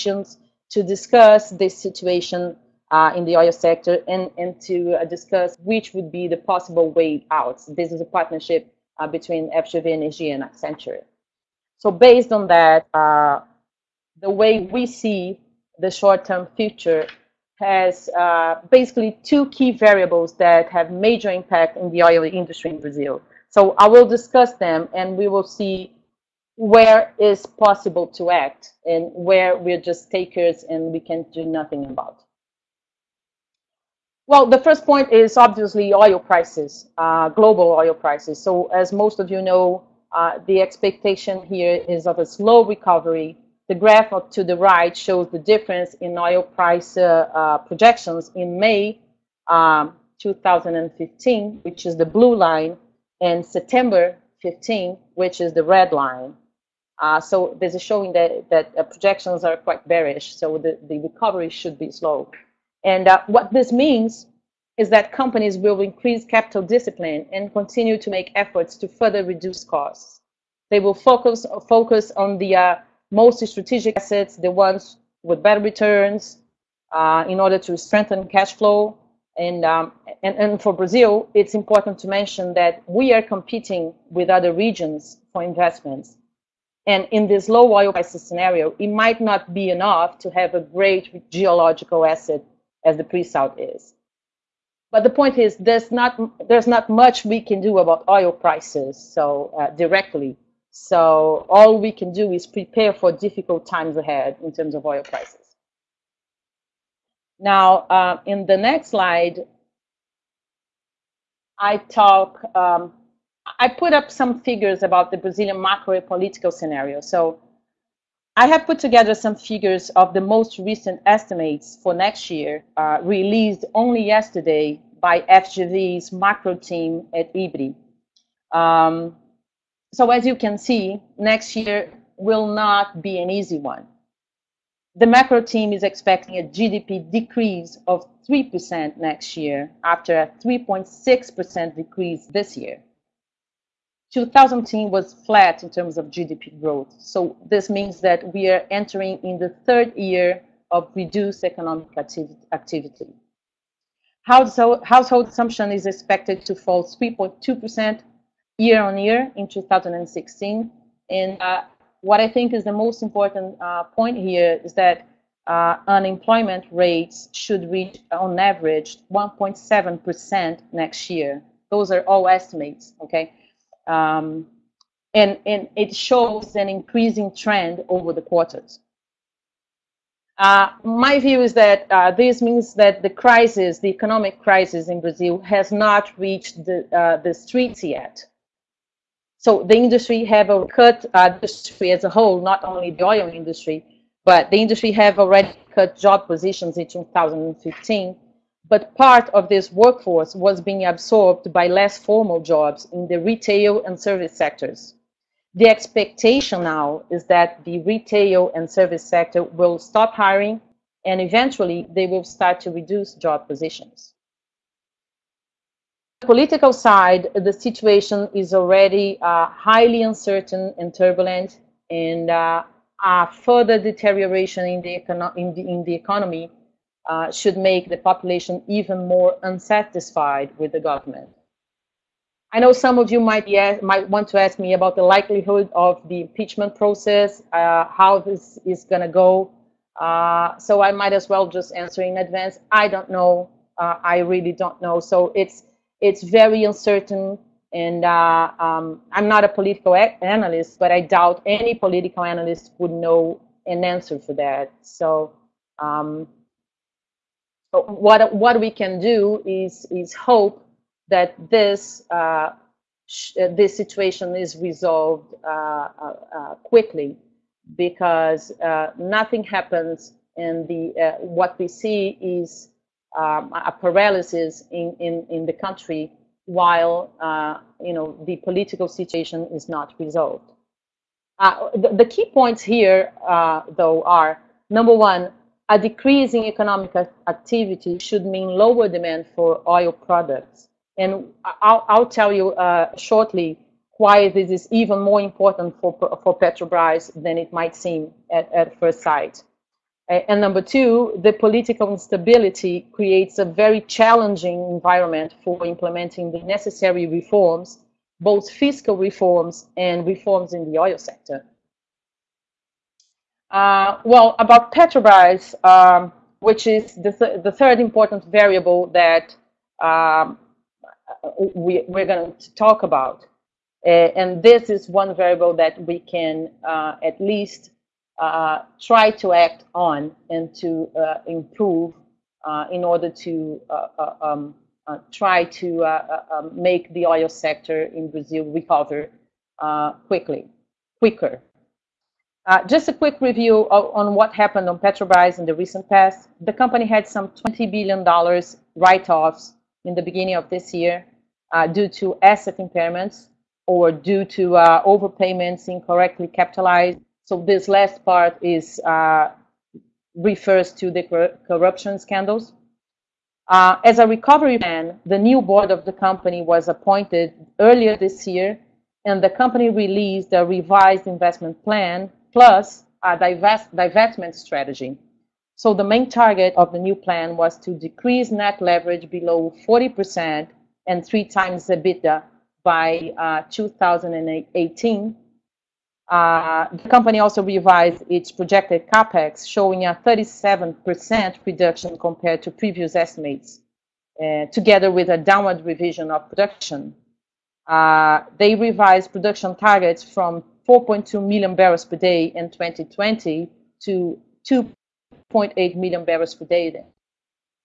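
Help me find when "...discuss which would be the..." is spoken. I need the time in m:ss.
0:05.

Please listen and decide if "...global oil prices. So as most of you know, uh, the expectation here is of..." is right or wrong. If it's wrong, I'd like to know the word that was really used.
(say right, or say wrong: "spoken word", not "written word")
right.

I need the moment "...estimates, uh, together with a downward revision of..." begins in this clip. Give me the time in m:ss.
6:32.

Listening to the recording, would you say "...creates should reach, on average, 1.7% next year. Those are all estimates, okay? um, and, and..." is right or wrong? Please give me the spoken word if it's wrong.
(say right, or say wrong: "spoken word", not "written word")
wrong: "rates", not "creates".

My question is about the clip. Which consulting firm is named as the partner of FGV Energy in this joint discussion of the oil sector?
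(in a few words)
Accenture.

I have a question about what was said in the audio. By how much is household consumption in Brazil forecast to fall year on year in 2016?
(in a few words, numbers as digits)
3.2%.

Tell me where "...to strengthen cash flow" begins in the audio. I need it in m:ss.
1:17.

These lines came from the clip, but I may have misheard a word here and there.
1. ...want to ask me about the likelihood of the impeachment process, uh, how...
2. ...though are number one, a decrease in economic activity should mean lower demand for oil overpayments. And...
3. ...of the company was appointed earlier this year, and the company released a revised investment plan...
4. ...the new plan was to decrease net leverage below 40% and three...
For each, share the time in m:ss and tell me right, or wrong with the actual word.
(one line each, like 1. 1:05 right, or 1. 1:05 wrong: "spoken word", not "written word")
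1. 3:54 right
2. 4:43 wrong: "products", not "overpayments"
3. 6:05 right
4. 6:16 right.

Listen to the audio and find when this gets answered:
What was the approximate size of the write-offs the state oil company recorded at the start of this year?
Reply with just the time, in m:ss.
5:47.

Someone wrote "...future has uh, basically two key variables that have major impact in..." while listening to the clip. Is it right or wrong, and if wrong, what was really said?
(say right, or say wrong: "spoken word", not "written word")
right.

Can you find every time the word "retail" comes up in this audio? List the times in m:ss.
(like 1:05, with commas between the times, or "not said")
3:23, 3:27.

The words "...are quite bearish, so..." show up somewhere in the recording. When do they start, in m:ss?
0:59.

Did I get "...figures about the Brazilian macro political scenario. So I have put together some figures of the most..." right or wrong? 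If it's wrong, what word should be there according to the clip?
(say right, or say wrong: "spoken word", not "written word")
right.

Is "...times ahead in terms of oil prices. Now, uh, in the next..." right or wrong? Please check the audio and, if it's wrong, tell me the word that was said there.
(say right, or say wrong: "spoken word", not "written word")
right.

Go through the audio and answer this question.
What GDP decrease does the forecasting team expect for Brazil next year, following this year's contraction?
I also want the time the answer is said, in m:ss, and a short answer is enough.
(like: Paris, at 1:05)
3%, at 2:18.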